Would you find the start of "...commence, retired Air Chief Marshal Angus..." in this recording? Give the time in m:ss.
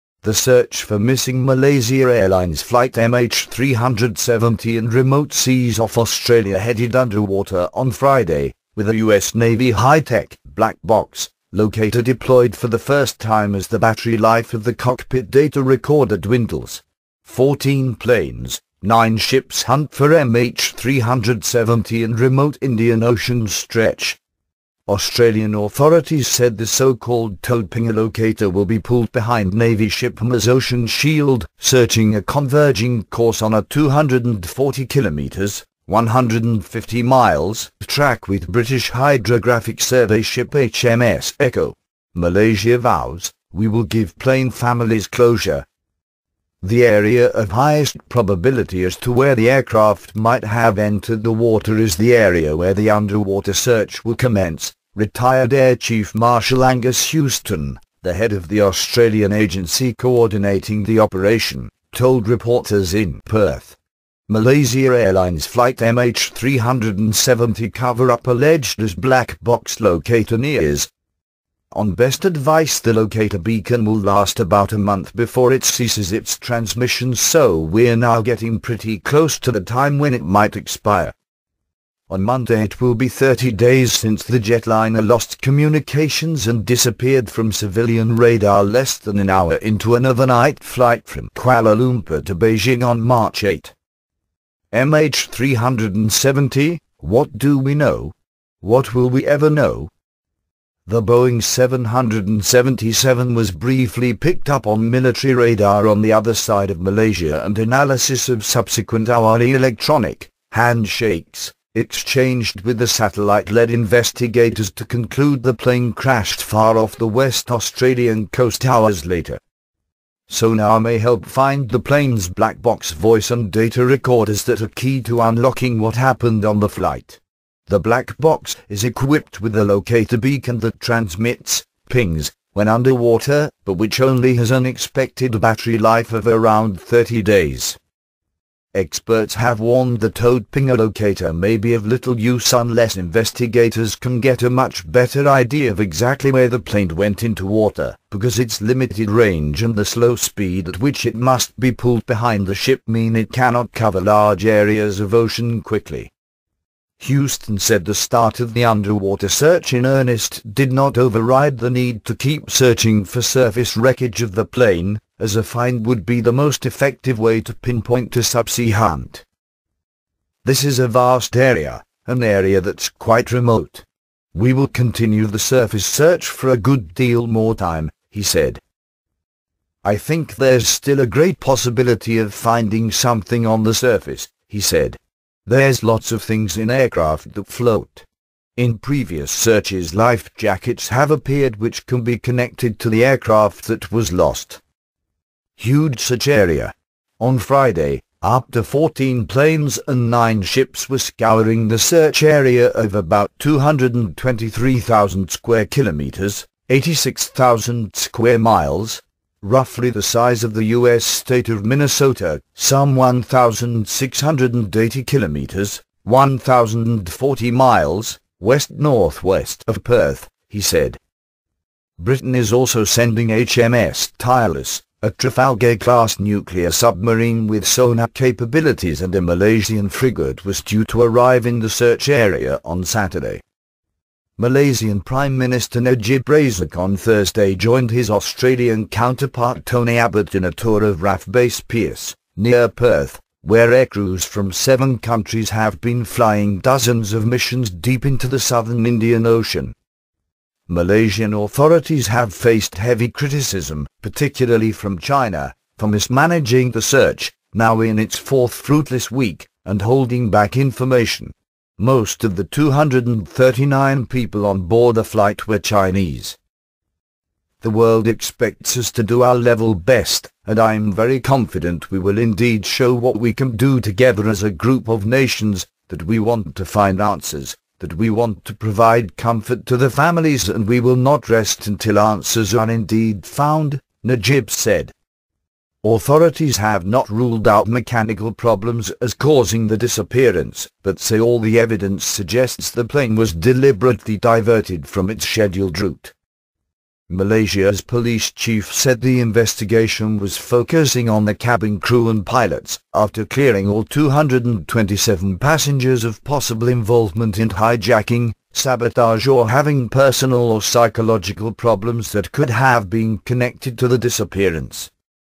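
0:54.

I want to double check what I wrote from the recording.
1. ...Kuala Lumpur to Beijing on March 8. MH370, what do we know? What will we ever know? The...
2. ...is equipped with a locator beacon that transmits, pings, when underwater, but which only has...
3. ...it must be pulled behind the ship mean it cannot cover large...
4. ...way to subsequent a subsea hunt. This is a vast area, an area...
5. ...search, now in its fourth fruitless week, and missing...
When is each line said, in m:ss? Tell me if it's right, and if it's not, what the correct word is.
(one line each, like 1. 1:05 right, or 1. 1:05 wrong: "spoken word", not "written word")
1. 1:31 right
2. 2:08 right
3. 2:31 right
4. 2:47 wrong: "pinpoint", not "subsequent"
5. 4:16 wrong: "holding", not "missing".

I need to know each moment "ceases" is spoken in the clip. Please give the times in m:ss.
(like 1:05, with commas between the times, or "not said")
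1:15.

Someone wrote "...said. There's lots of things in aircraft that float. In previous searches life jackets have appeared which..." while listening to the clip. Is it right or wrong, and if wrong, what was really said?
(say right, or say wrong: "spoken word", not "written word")
right.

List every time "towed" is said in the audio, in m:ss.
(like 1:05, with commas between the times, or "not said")
0:27, 2:20.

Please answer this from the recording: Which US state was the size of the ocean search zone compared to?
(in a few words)
Minnesota.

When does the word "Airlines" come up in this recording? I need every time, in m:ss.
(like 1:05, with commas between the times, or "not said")
0:02, 1:04.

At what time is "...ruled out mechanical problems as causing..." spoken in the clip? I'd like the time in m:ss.
4:47.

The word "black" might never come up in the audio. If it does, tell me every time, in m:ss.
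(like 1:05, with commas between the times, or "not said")
0:10, 1:08, 2:02, 2:07.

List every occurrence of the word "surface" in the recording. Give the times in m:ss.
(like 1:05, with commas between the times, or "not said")
2:43, 2:55, 3:03.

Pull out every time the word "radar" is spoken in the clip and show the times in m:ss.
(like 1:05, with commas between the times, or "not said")
1:28, 1:45.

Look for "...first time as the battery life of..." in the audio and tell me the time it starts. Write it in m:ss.
0:12.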